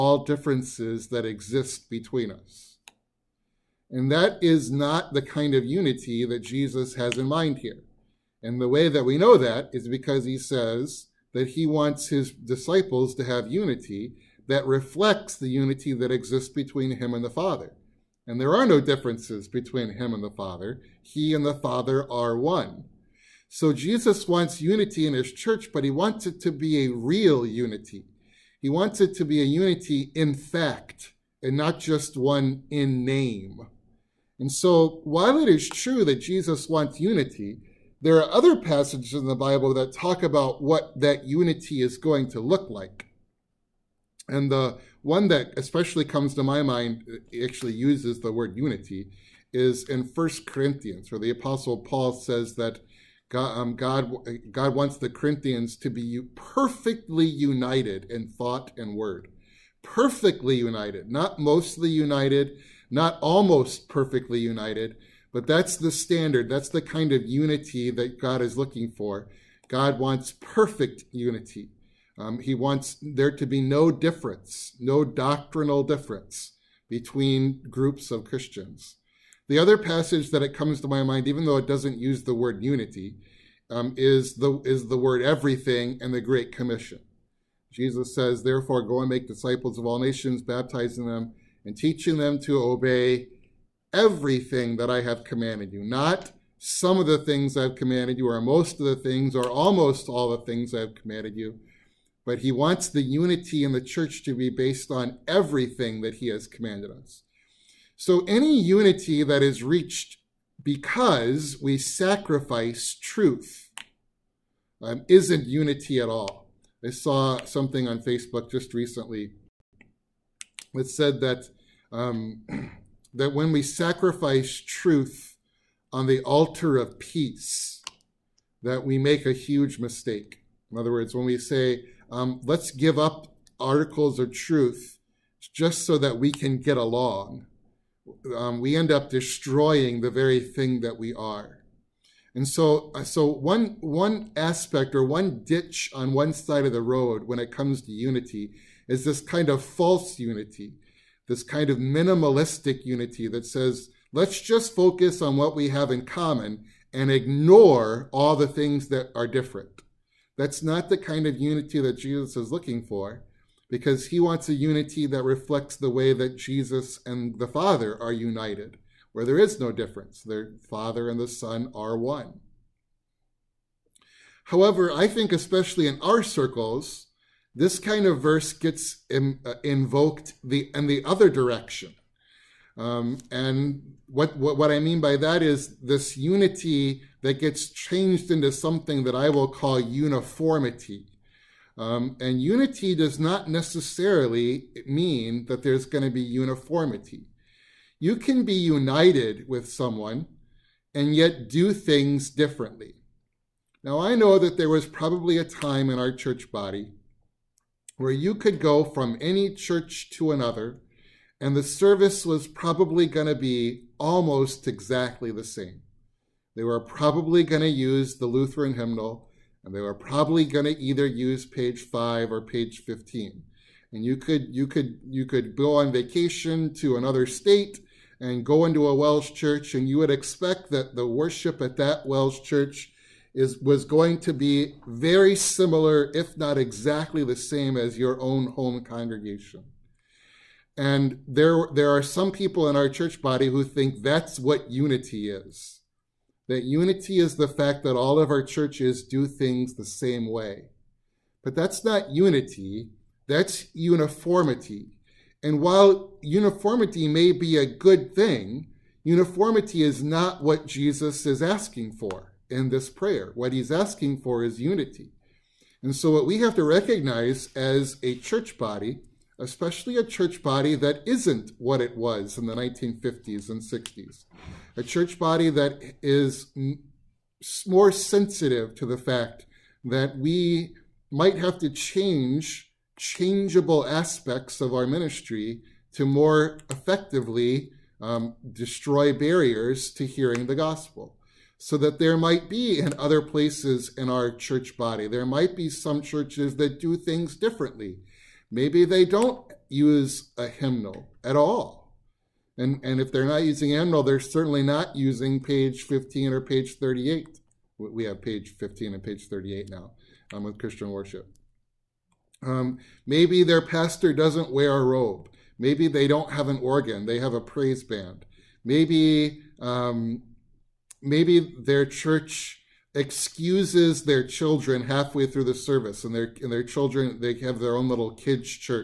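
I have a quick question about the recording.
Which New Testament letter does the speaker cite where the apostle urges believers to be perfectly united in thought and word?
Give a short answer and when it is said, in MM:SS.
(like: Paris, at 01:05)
First Corinthians, at 00:50.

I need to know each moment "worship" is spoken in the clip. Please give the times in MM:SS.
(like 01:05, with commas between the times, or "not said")
03:51, 05:10.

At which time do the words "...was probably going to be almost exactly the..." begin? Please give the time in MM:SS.
03:32.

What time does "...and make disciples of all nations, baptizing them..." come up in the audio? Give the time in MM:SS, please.
01:28.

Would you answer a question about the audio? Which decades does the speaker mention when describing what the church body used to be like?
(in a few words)
1950s and 60s.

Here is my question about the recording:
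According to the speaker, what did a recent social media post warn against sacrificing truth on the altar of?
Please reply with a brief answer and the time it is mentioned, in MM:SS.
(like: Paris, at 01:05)
peace, at 02:06.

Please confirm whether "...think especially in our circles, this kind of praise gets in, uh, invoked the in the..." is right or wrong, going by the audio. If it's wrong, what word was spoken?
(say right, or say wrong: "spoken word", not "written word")
wrong: "verse", not "praise".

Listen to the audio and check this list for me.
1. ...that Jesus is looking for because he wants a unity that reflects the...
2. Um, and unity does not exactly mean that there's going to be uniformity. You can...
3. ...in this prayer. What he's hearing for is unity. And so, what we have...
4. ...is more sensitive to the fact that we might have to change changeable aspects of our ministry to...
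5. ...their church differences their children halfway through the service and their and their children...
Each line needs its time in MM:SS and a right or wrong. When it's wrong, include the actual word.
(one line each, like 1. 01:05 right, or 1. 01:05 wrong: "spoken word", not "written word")
1. 02:41 right
2. 03:11 wrong: "necessarily", not "exactly"
3. 04:22 wrong: "asking", not "hearing"
4. 04:36 right
5. 05:21 wrong: "excuses", not "differences".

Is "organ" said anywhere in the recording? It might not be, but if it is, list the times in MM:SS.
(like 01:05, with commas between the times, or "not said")
05:16.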